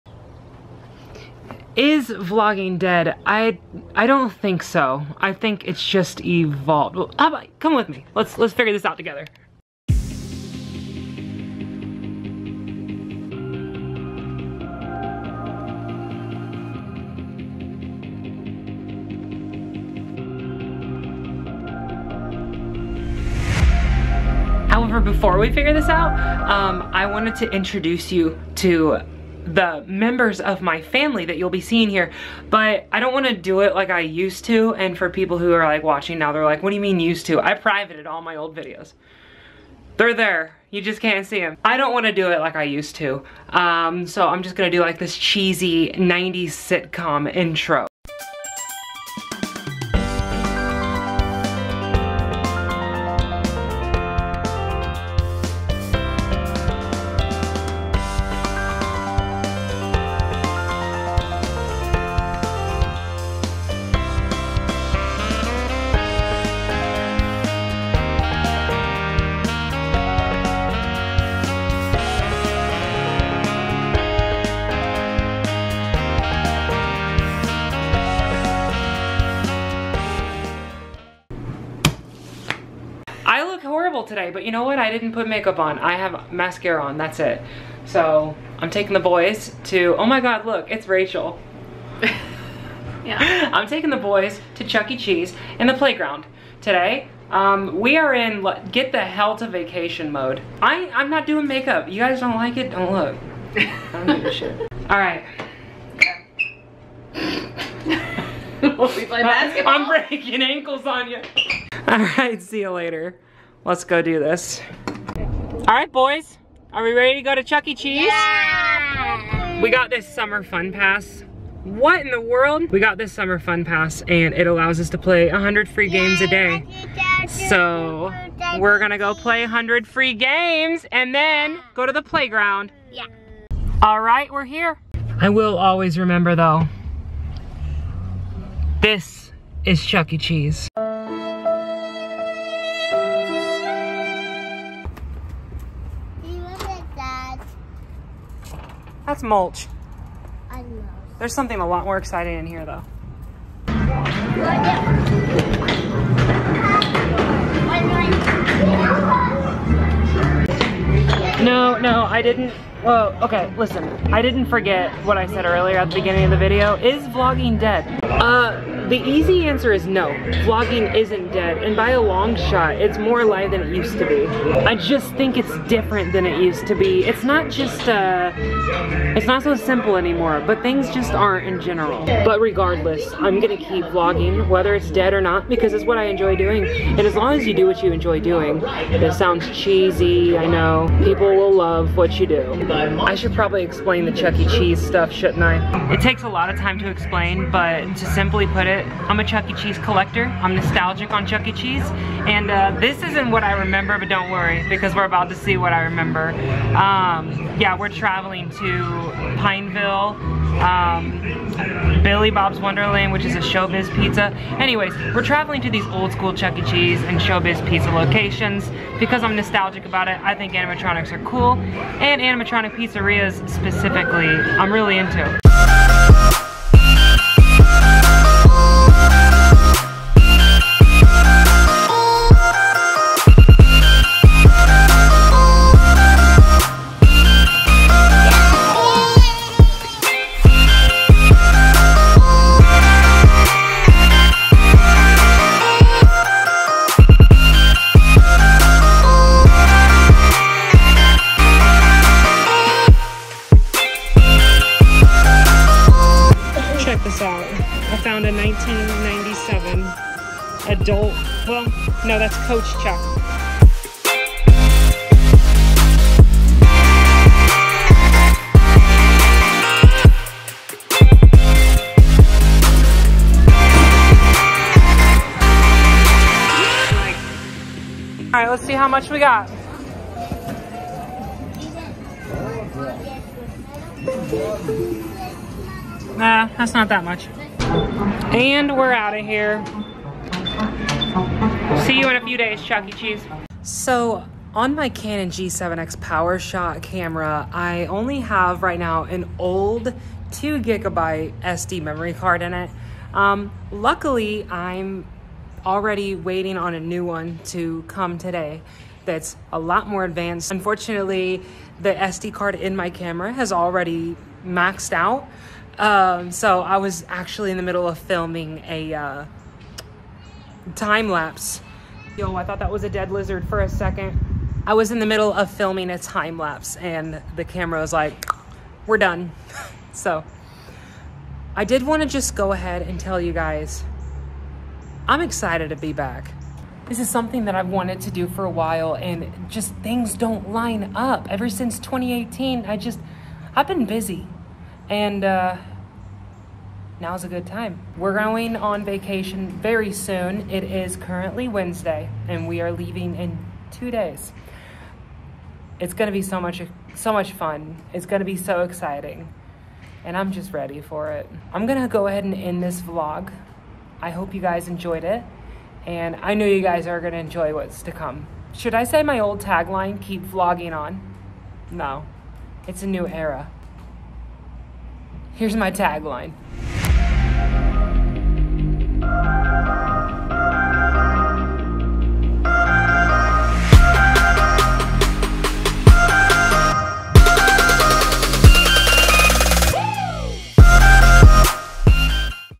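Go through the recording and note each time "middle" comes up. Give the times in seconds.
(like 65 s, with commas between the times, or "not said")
317 s, 325 s.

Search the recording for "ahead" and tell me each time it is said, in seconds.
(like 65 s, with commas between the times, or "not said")
332 s, 362 s.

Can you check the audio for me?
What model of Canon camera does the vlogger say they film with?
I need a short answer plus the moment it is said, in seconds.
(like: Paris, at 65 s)
G7X PowerShot, at 295 s.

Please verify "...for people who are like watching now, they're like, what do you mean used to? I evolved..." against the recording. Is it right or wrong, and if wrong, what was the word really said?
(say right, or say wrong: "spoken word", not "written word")
wrong: "privated", not "evolved".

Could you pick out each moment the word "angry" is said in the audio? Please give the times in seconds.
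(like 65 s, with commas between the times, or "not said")
not said.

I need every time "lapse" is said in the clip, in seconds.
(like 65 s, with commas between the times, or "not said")
321 s, 326 s.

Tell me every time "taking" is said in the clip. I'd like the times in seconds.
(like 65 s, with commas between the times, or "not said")
88 s, 93 s.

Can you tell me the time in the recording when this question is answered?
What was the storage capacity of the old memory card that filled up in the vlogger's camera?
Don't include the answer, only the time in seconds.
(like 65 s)
300 s.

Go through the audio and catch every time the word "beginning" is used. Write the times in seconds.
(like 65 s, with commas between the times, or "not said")
165 s.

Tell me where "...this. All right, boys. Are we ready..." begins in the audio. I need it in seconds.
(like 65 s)
114 s.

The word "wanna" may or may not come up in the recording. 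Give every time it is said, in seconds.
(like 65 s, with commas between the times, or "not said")
33 s, 41 s.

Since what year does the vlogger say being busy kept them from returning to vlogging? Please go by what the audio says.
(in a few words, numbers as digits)
2018.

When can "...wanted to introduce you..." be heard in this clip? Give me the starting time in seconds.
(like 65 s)
27 s.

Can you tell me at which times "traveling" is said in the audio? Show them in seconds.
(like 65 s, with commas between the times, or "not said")
207 s, 215 s.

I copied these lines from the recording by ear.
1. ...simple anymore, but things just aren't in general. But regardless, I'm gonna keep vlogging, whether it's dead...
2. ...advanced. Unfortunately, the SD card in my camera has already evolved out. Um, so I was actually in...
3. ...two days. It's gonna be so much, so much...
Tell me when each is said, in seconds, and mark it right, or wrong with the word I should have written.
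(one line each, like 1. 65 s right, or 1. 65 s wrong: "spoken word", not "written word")
1. 179 s right
2. 310 s wrong: "maxed", not "evolved"
3. 353 s right.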